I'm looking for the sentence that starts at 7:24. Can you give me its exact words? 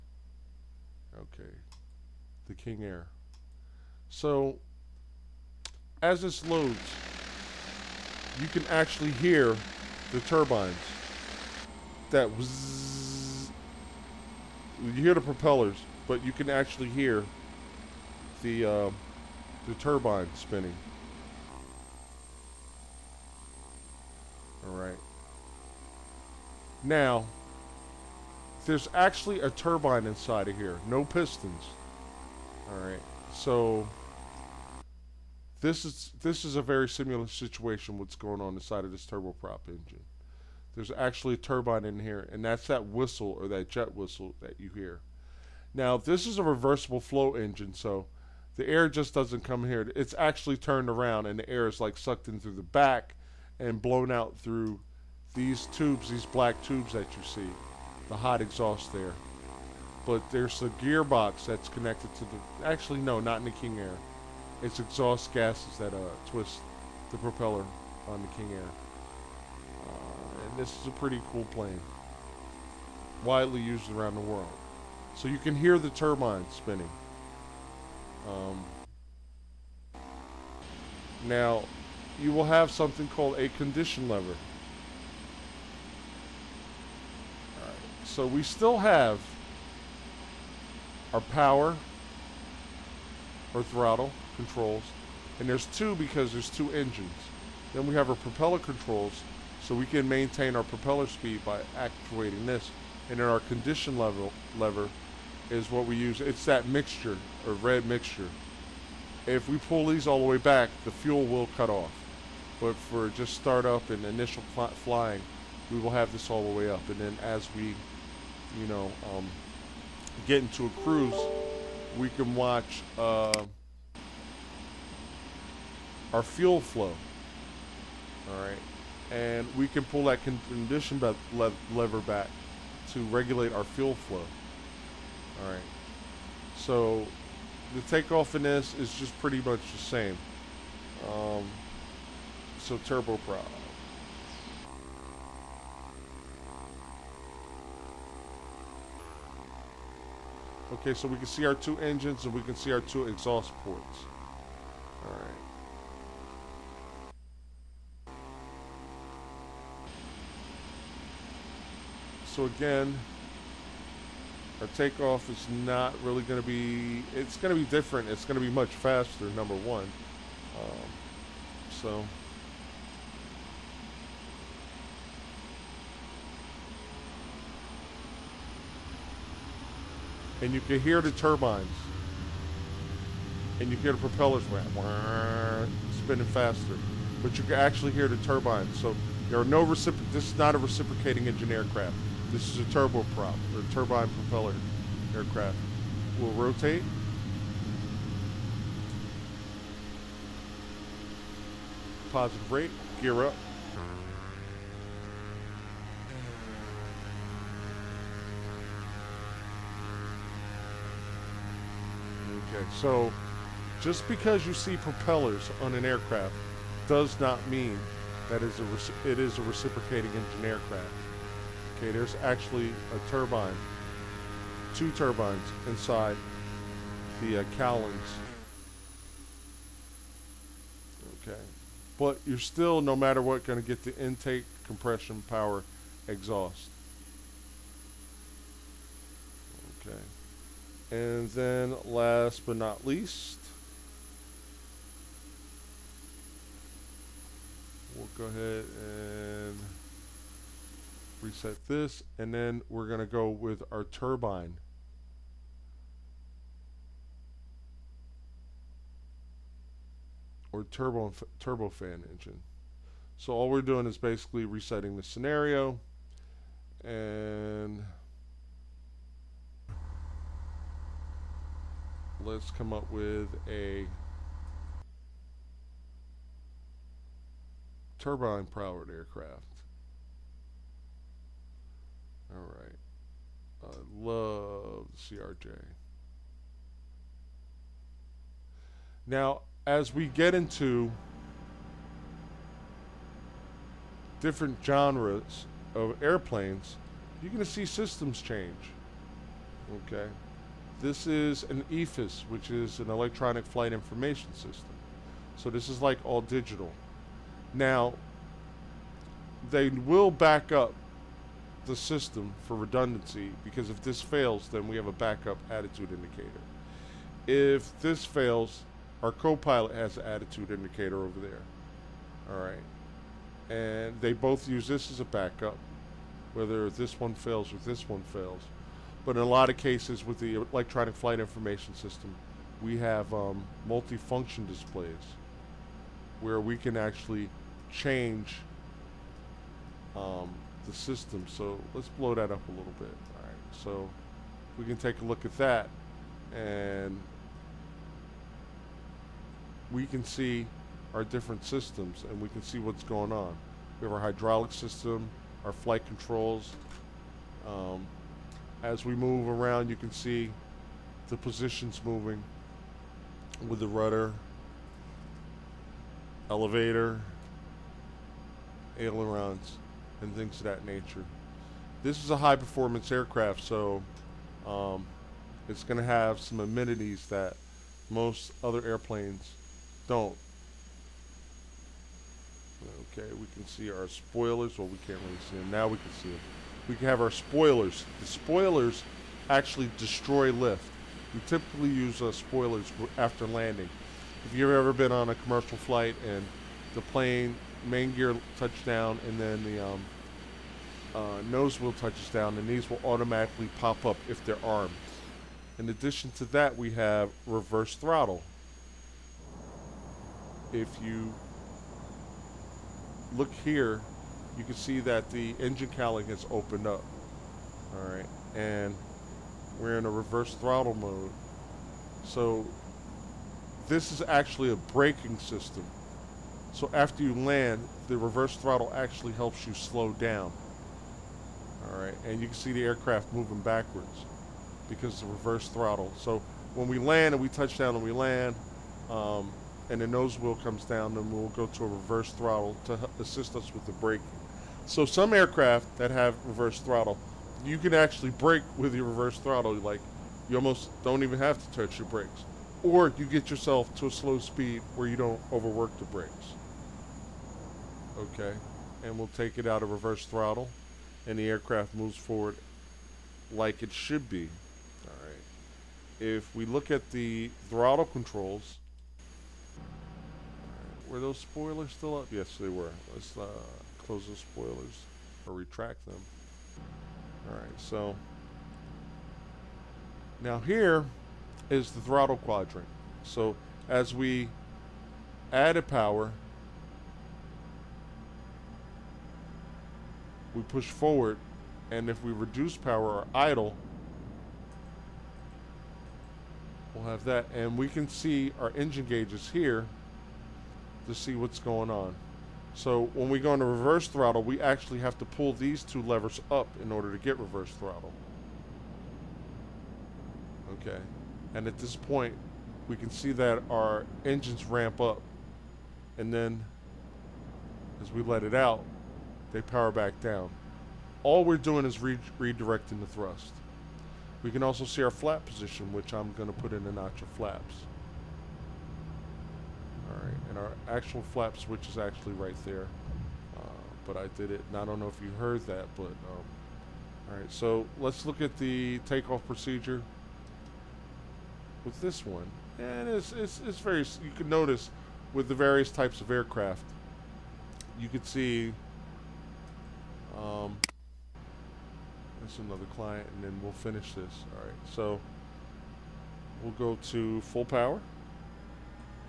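So some aircraft that have reverse throttle, you can actually brake with your reverse throttle.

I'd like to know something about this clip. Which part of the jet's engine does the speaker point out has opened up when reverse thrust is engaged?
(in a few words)
Engine cowling.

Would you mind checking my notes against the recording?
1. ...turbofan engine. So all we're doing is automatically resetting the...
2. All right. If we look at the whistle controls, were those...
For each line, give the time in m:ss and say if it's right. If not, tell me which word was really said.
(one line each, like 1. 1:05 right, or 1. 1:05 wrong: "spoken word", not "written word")
1. 4:21 wrong: "basically", not "automatically"
2. 7:44 wrong: "throttle", not "whistle".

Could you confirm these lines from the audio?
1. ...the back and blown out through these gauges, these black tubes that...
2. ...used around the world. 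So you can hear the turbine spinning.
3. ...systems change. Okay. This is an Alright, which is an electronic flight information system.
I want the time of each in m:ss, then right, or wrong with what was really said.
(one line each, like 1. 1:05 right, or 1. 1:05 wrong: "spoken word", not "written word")
1. 0:52 wrong: "tubes", not "gauges"
2. 1:13 right
3. 4:57 wrong: "EFIS", not "Alright".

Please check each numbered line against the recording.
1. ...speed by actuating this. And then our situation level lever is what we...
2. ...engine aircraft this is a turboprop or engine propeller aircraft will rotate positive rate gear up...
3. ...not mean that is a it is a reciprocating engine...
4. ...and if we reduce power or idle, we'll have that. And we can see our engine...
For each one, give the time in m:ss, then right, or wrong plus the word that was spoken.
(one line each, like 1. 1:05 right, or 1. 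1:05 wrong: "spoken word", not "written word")
1. 1:41 wrong: "condition", not "situation"
2. 3:11 wrong: "turbine", not "engine"
3. 3:37 right
4. 8:11 right.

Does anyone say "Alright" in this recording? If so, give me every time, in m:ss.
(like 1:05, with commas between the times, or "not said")
0:32, 2:35, 6:57, 7:11, 7:57, 8:49, 8:57, 9:14.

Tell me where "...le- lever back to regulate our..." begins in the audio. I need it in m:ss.
2:11.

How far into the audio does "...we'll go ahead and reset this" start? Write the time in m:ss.
4:07.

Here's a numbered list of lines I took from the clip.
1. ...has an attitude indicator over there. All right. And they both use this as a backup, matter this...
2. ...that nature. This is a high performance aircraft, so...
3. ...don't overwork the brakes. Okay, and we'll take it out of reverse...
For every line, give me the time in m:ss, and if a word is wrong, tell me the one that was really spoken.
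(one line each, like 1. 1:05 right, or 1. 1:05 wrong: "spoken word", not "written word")
1. 5:19 wrong: "whether", not "matter"
2. 6:10 right
3. 7:34 right.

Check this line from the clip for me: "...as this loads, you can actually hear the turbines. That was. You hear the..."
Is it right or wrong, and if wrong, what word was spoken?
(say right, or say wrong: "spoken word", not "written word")
right.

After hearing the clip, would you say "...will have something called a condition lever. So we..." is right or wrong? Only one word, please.
right.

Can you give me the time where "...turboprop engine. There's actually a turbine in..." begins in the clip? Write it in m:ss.
0:39.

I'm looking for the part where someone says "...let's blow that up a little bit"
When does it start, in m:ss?
5:41.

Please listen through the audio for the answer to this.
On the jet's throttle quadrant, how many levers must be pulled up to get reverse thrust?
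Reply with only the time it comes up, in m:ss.
8:25.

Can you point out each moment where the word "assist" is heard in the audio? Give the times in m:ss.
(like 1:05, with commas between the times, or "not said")
7:22.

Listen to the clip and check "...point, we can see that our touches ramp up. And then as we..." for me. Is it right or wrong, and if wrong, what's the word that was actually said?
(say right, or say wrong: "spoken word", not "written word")
wrong: "engines", not "touches".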